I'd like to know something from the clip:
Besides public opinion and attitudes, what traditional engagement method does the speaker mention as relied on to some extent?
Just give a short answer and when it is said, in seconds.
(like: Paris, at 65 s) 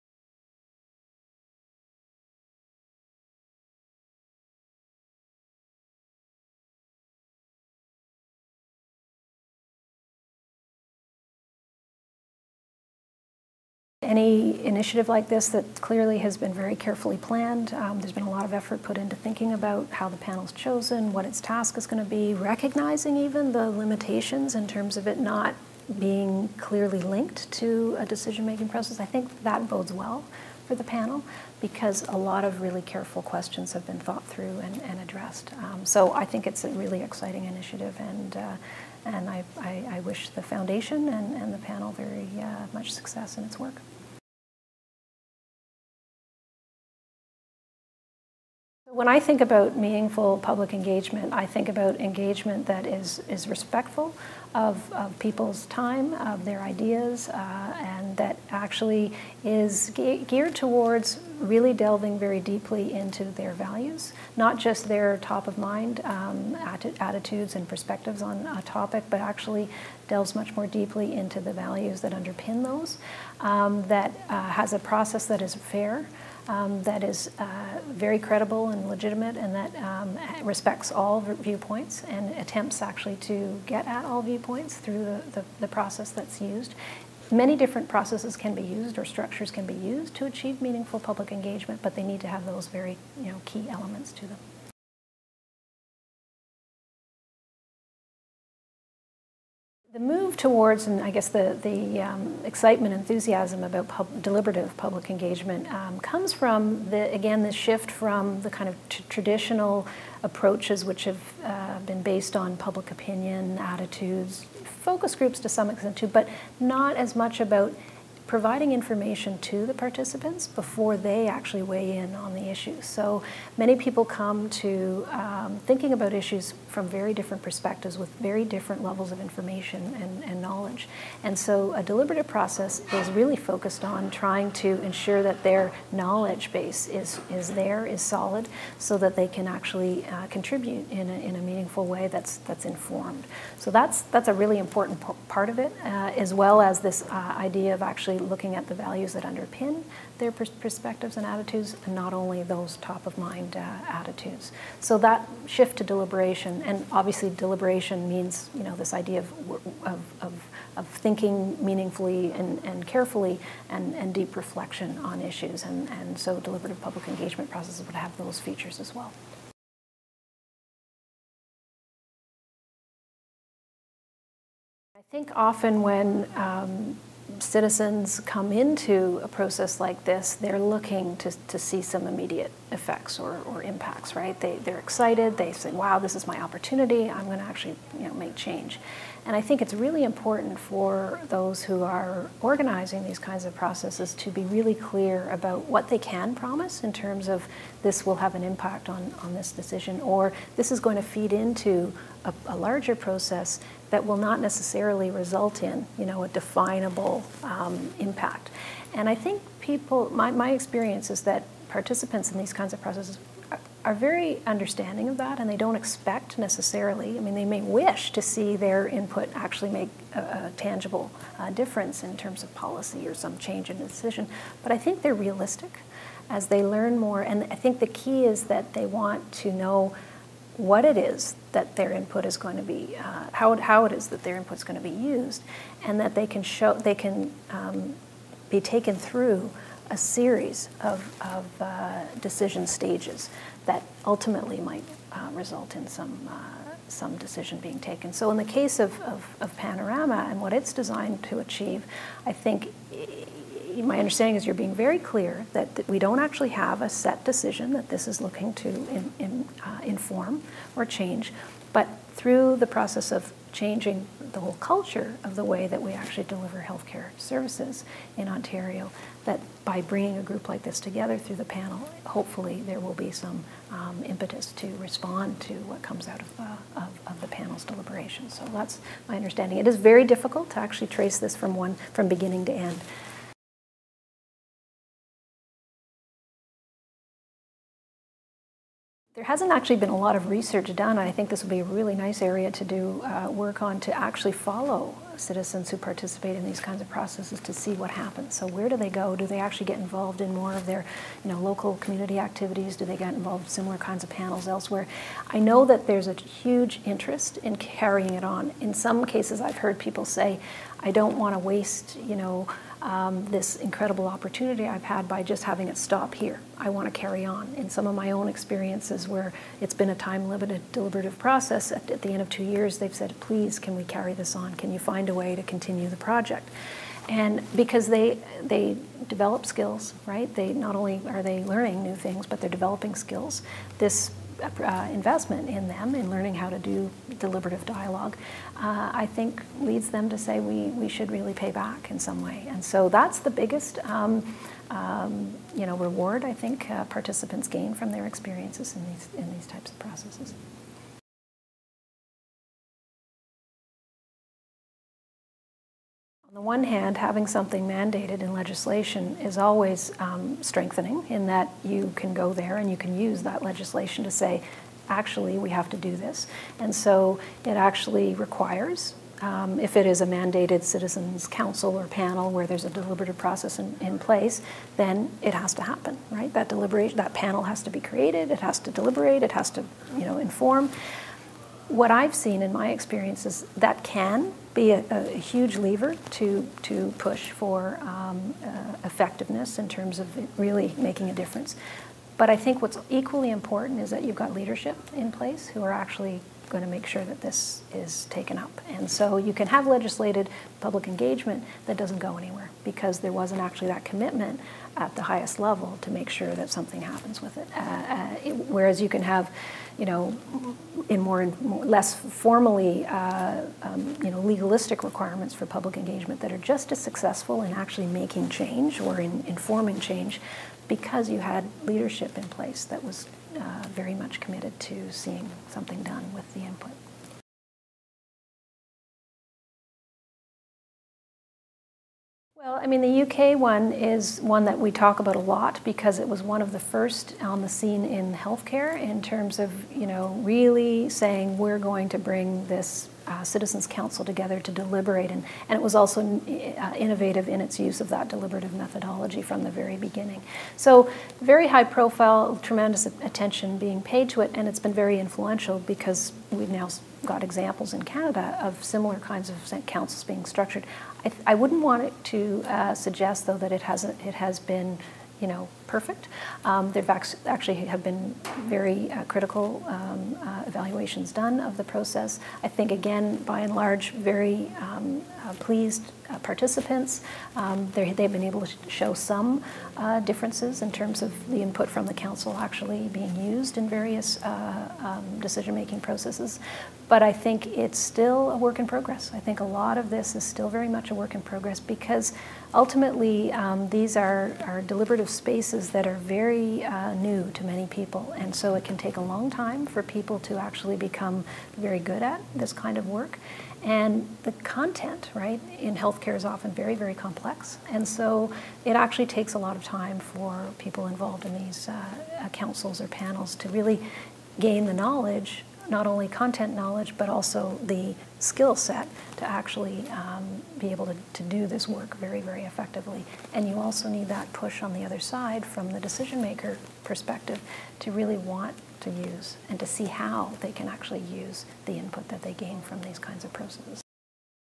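focus groups, at 114 s.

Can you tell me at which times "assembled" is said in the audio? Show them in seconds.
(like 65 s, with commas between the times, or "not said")
not said.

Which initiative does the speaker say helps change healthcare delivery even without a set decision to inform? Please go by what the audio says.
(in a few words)
Panorama.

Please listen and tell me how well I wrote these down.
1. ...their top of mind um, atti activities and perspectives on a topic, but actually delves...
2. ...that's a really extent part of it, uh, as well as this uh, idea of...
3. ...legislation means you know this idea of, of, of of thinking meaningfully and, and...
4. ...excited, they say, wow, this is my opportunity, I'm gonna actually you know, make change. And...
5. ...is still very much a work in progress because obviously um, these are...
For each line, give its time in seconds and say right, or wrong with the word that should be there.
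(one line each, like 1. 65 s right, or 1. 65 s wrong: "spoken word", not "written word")
1. 64 s wrong: "attitudes", not "activities"
2. 144 s wrong: "important", not "extent"
3. 157 s wrong: "deliberation", not "legislation"
4. 184 s right
5. 490 s wrong: "ultimately", not "obviously".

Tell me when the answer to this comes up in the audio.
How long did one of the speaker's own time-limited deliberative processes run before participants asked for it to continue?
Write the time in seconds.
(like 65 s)
322 s.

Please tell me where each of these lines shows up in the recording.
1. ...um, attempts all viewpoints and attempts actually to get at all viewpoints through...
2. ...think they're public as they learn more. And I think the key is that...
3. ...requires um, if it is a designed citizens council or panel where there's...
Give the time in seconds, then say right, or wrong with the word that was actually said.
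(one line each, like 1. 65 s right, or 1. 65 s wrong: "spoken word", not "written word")
1. 79 s wrong: "respects", not "attempts"
2. 224 s wrong: "realistic", not "public"
3. 368 s wrong: "mandated", not "designed".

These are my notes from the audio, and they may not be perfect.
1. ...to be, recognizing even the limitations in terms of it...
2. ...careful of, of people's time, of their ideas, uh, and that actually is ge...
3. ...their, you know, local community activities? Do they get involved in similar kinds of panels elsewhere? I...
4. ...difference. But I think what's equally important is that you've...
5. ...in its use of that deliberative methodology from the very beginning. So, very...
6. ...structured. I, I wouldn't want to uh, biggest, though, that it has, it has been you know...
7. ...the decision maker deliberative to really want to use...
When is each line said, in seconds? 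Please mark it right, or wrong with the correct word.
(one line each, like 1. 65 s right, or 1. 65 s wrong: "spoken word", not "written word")
1. 22 s right
2. 53 s wrong: "respectful", not "careful"
3. 300 s right
4. 391 s right
5. 447 s right
6. 460 s wrong: "suggest", not "biggest"
7. 525 s wrong: "perspective", not "deliberative".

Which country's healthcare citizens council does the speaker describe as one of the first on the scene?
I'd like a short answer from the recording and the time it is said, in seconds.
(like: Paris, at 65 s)
UK, at 433 s.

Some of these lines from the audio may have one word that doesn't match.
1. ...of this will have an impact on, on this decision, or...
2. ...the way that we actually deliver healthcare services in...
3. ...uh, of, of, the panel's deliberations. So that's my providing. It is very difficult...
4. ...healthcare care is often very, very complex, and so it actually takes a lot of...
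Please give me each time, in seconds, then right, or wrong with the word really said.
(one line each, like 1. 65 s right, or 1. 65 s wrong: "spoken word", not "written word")
1. 197 s right
2. 265 s right
3. 276 s wrong: "understanding", not "providing"
4. 505 s right.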